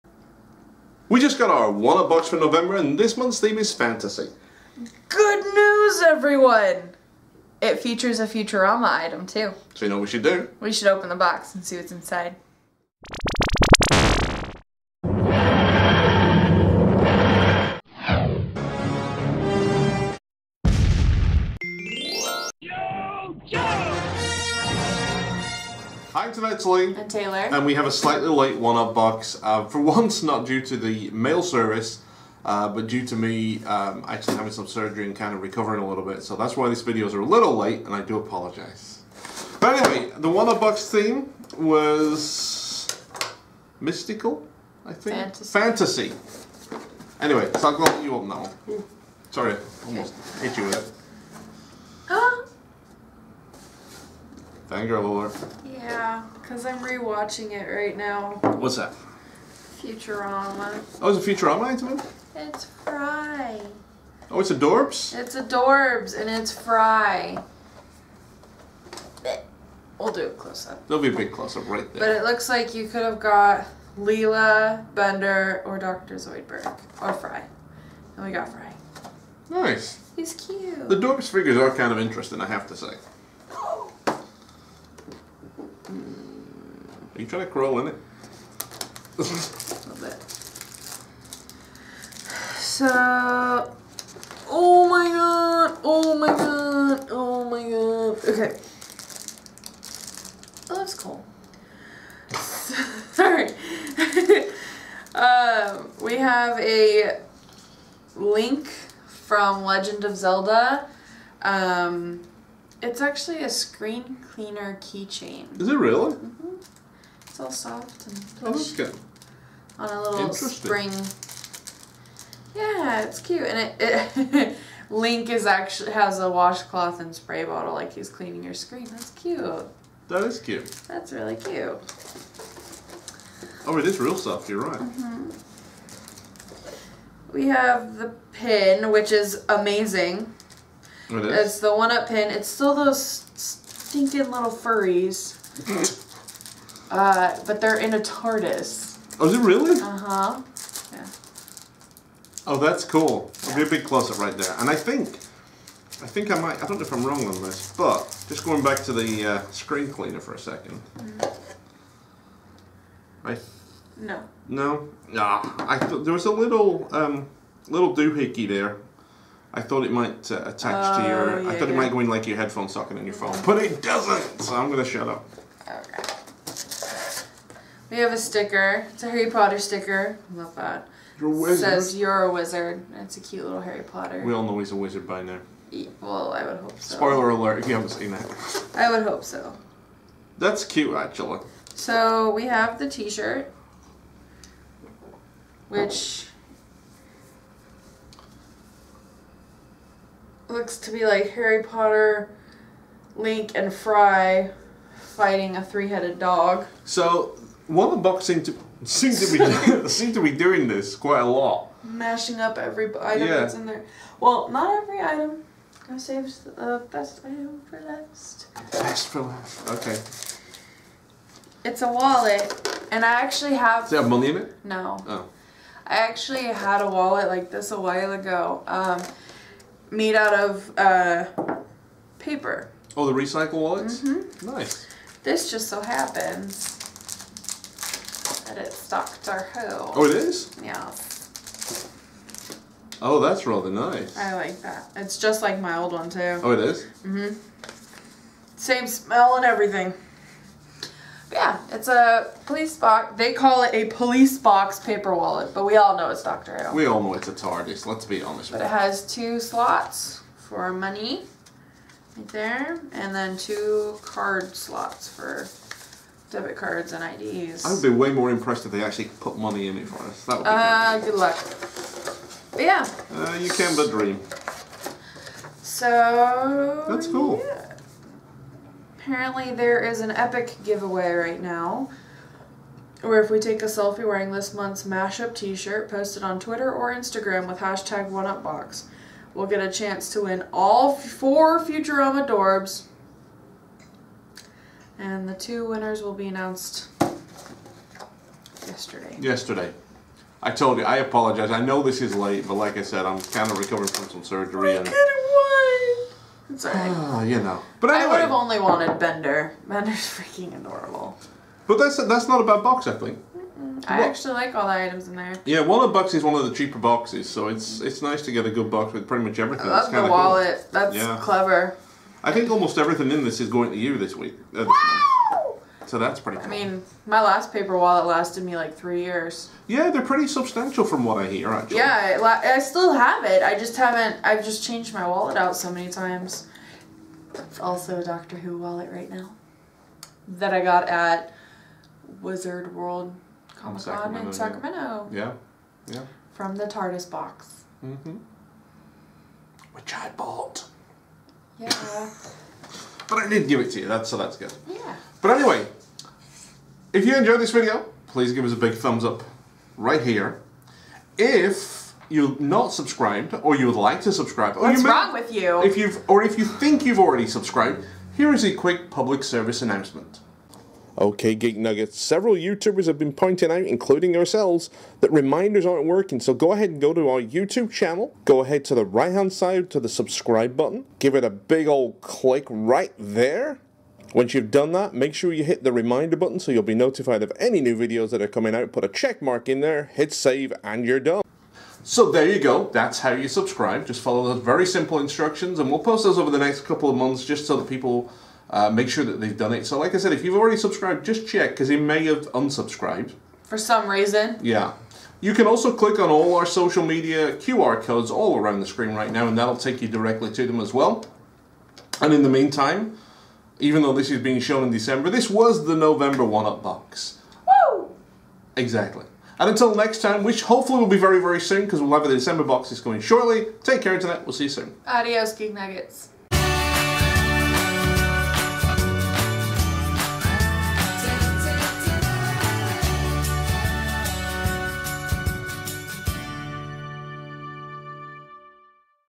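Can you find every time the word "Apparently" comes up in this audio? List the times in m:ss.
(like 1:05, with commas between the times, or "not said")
4:38.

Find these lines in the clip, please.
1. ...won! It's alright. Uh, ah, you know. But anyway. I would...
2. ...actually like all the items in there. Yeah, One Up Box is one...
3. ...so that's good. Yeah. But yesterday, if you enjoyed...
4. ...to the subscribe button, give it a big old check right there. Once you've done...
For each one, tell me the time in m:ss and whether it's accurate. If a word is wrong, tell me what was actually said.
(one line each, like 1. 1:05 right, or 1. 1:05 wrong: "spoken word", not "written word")
1. 5:05 right
2. 5:14 right
3. 5:54 wrong: "anyway", not "yesterday"
4. 6:19 wrong: "click", not "check".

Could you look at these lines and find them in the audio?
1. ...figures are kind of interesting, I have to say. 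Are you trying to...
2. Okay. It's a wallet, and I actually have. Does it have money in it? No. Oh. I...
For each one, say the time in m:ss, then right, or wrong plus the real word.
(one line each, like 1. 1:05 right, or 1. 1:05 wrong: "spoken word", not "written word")
1. 1:21 right
2. 3:39 right.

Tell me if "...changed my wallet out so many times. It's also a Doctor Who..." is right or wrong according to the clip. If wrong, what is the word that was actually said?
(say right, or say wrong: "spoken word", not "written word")
right.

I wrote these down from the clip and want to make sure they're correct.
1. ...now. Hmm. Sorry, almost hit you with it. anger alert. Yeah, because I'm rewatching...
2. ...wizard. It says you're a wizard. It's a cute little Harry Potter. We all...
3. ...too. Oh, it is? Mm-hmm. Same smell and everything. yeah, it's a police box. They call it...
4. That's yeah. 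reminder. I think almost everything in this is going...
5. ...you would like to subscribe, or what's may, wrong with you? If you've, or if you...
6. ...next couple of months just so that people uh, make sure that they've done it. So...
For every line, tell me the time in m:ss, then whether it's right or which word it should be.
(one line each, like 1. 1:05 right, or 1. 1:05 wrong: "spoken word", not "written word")
1. 0:48 right
2. 3:01 right
3. 4:06 right
4. 5:20 wrong: "clever", not "reminder"
5. 6:03 right
6. 6:36 right.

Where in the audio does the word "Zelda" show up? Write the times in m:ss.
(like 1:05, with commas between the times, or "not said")
1:50.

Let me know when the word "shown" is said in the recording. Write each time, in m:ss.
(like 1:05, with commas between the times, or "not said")
6:54.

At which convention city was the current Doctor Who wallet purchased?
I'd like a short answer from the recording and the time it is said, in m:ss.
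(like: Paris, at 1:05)
Sacramento, at 5:44.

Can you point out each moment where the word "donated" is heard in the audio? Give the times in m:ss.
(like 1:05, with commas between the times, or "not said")
not said.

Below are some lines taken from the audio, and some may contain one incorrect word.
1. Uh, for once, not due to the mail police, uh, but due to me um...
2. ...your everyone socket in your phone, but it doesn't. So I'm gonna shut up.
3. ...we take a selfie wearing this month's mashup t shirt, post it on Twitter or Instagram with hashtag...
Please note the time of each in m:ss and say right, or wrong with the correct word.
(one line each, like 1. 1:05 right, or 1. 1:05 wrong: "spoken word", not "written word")
1. 0:29 wrong: "service", not "police"
2. 2:52 wrong: "headphone", not "everyone"
3. 4:43 right.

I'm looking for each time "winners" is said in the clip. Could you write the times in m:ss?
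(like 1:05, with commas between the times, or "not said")
4:55.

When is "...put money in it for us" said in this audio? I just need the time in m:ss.
4:29.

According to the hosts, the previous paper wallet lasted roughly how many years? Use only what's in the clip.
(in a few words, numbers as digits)
3.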